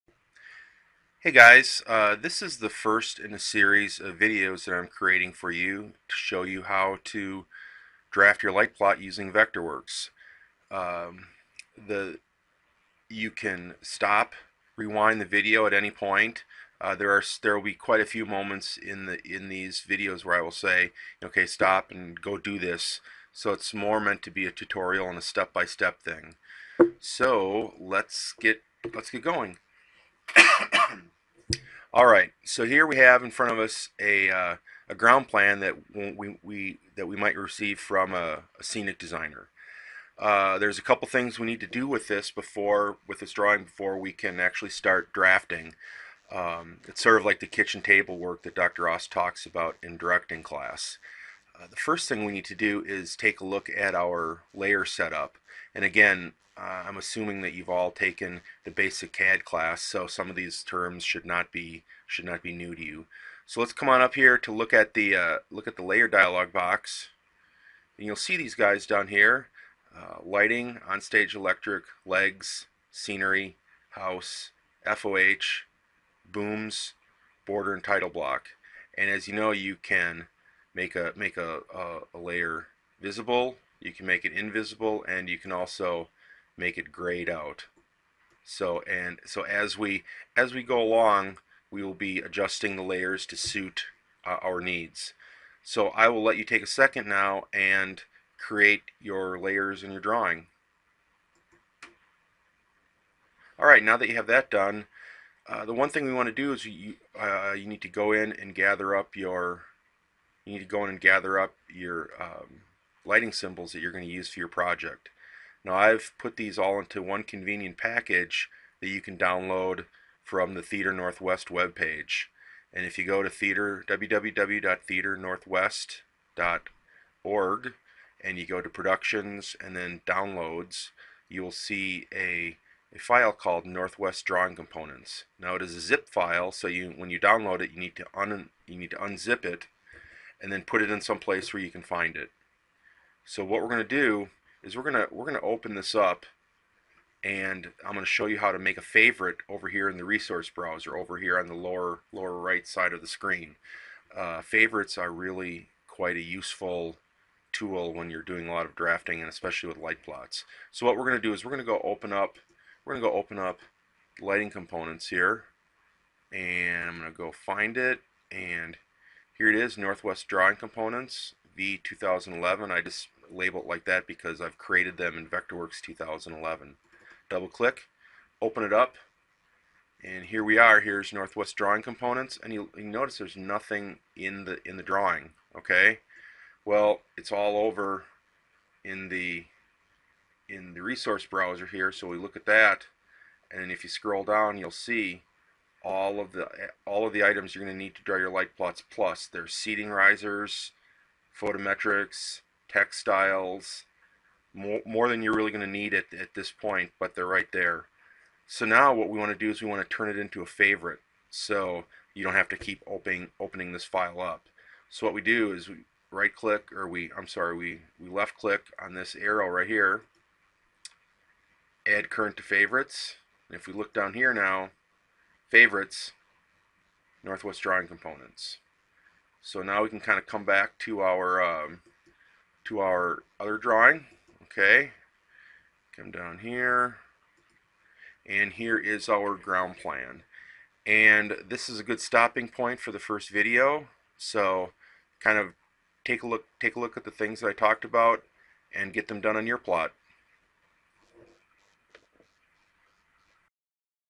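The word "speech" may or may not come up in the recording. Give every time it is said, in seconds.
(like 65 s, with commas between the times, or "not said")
not said.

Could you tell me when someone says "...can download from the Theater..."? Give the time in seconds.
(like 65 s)
119 s.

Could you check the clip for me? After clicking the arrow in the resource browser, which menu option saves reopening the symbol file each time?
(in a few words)
Add current to favorites.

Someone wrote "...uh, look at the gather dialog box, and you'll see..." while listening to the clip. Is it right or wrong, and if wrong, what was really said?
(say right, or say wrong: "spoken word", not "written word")
wrong: "layer", not "gather".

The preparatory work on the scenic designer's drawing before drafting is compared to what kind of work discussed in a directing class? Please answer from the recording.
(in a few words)
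Kitchen table work.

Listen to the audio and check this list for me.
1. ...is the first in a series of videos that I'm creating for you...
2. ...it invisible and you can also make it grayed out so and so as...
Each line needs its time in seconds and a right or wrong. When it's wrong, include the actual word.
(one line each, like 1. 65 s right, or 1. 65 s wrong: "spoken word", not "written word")
1. 2 s right
2. 84 s right.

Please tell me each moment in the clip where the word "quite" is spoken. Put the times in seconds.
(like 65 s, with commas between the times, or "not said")
17 s, 155 s.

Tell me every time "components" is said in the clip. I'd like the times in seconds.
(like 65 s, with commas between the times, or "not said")
134 s, 164 s, 170 s, 181 s, 227 s.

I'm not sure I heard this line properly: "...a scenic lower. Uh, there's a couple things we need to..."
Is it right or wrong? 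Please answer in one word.
wrong.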